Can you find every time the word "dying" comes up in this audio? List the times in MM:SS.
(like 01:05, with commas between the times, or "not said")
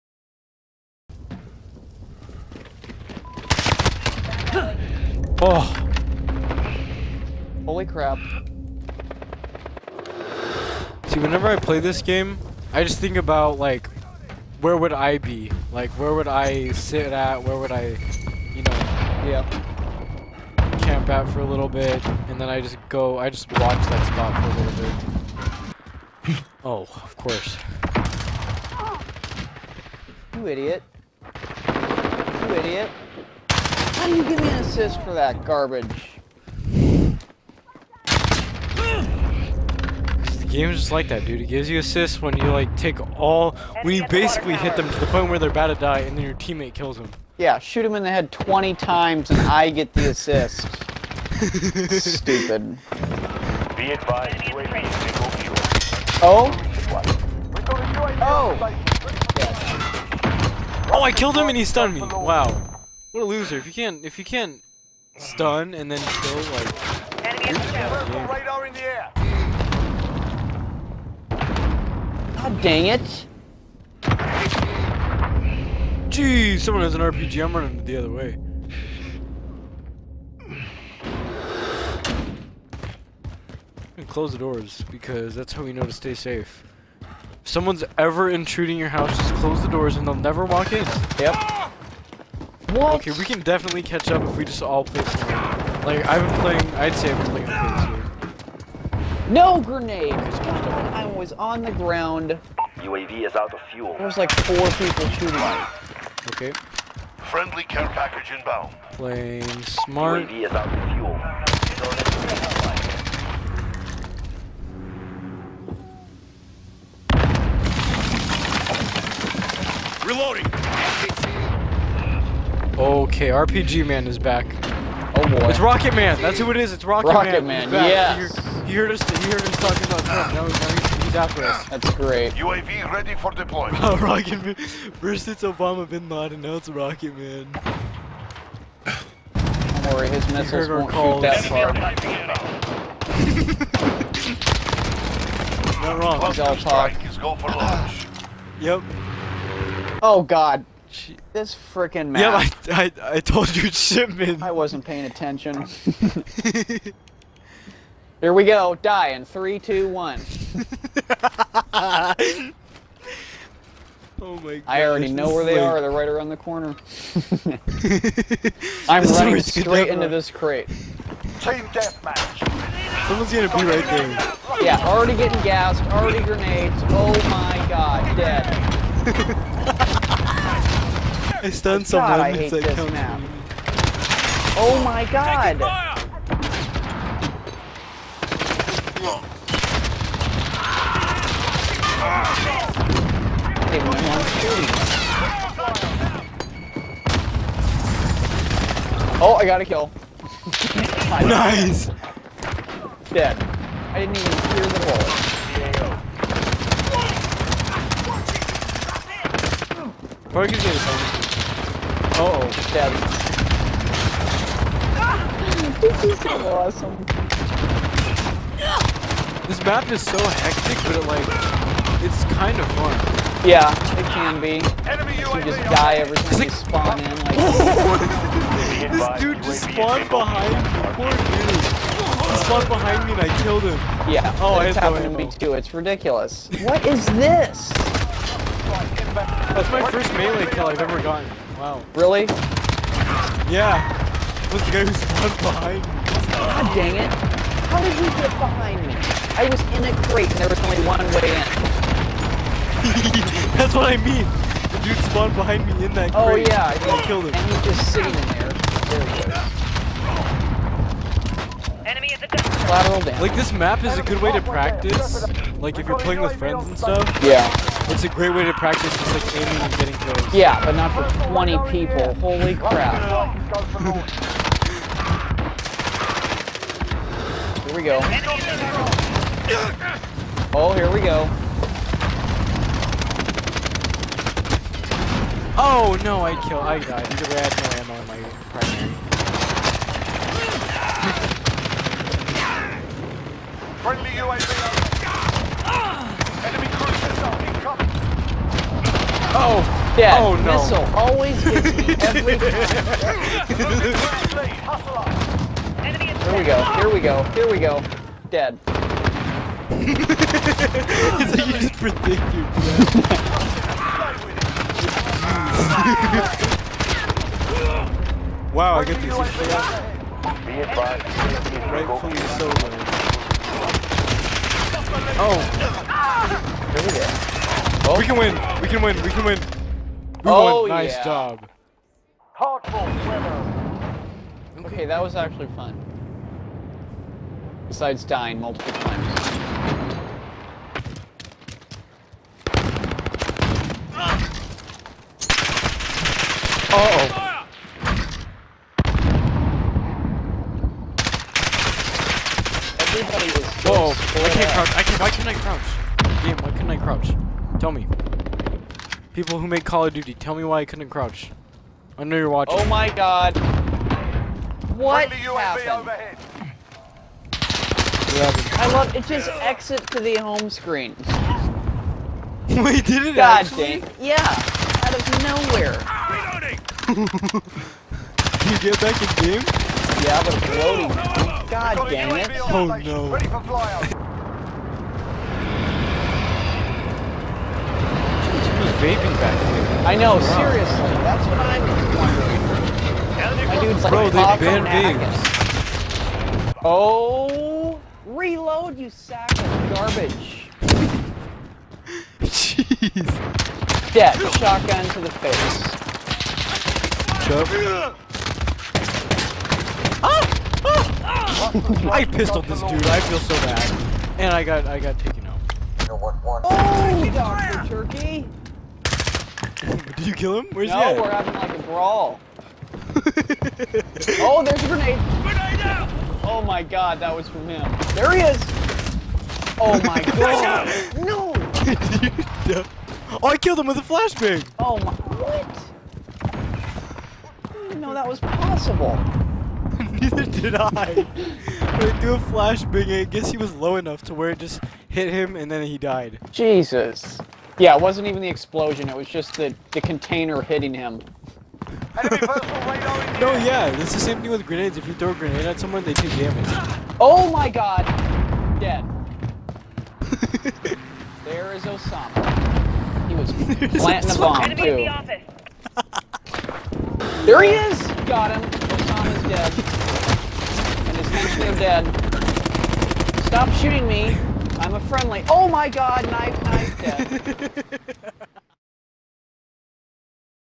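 05:38.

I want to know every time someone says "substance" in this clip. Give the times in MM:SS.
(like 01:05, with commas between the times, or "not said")
not said.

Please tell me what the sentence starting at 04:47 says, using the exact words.
Either way, I had no ammo in my primary.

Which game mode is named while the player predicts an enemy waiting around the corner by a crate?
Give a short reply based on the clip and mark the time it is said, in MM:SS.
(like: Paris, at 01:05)
Team deathmatch, at 02:50.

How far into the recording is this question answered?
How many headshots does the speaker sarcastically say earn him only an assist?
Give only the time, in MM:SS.
00:48.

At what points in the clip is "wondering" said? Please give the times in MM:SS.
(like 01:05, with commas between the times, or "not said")
06:33.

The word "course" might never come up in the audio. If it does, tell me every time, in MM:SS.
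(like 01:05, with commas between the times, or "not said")
00:27.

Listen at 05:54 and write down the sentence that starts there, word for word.
I can why can't I crouch?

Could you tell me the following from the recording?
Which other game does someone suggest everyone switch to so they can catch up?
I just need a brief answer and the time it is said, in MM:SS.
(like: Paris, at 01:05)
Fortnite, at 01:35.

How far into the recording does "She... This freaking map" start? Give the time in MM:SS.
02:30.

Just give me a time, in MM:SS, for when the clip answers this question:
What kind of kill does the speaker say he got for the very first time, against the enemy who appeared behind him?
04:00.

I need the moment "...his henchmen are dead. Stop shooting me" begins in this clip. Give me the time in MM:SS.
07:50.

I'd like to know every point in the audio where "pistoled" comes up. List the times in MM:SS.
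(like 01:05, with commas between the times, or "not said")
06:52.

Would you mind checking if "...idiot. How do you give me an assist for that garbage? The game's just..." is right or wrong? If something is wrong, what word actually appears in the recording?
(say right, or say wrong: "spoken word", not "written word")
right.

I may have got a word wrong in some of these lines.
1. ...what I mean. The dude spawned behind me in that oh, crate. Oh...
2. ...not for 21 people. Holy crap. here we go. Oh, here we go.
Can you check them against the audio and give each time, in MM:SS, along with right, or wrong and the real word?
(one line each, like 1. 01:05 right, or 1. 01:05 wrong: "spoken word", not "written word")
1. 04:13 right
2. 04:30 wrong: "20", not "21".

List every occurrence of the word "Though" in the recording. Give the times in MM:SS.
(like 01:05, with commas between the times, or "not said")
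05:22.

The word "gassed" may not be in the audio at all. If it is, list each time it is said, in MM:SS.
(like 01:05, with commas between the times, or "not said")
02:55.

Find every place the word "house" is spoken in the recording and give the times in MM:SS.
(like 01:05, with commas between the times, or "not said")
01:28.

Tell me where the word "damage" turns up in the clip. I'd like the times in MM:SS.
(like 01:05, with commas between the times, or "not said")
04:22, 07:36.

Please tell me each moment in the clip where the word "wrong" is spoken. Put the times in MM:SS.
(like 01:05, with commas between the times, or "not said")
02:26.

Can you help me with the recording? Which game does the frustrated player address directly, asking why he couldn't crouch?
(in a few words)
Call of Duty.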